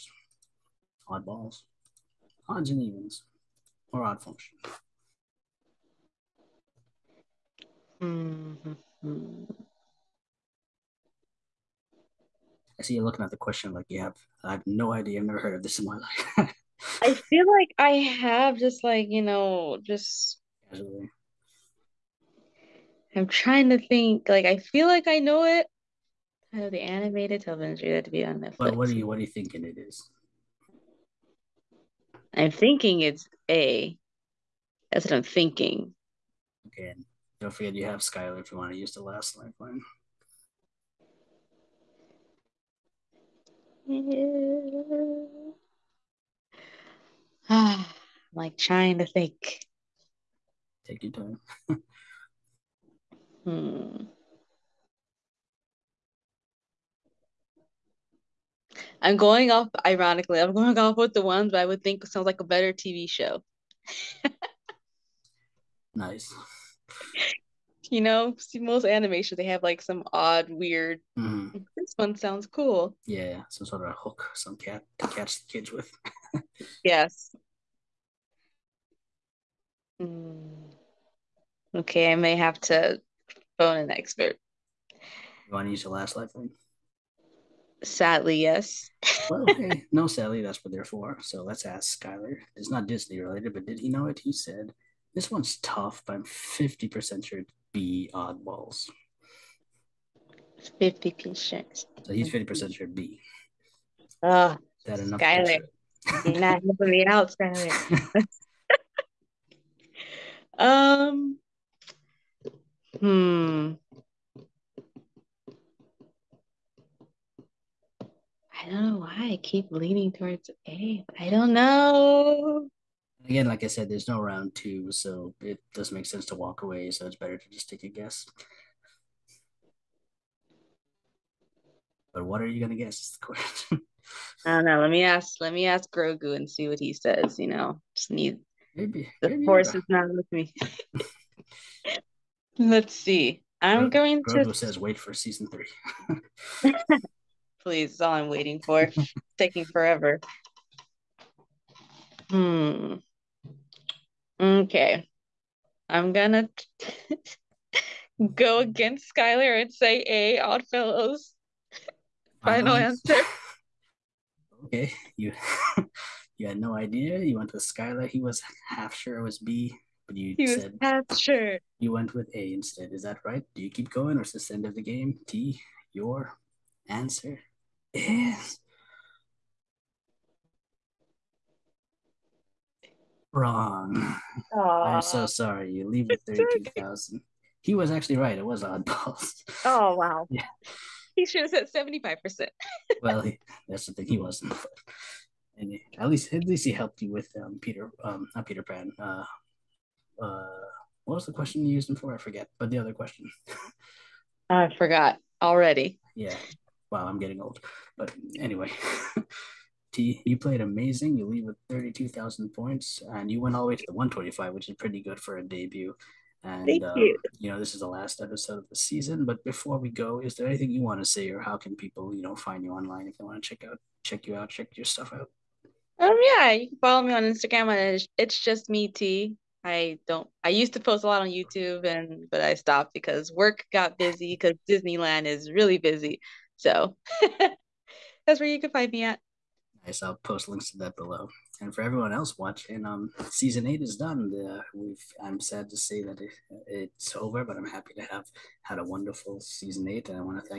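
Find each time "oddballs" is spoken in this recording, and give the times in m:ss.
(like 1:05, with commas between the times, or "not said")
0:01, 1:38, 3:08.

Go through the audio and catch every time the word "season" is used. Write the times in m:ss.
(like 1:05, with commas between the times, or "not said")
2:25, 3:38, 4:03, 4:09.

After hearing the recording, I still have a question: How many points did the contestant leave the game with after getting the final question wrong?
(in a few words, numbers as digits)
32,000.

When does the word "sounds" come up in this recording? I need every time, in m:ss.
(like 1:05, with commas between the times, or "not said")
1:02, 1:12.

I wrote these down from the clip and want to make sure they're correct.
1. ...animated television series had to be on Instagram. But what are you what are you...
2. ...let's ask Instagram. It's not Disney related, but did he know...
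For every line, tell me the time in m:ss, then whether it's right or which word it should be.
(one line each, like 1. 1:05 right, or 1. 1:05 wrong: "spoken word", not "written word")
1. 0:26 wrong: "Netflix", not "Instagram"
2. 1:31 wrong: "Skyler", not "Instagram".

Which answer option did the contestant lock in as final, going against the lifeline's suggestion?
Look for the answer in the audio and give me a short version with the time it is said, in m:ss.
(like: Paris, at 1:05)
Odd Fellows, at 2:40.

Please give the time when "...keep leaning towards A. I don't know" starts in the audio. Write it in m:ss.
1:59.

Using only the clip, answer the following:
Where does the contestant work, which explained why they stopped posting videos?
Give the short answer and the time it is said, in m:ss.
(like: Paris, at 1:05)
Disneyland, at 3:54.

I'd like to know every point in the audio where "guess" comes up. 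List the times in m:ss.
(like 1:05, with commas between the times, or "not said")
2:07, 2:12.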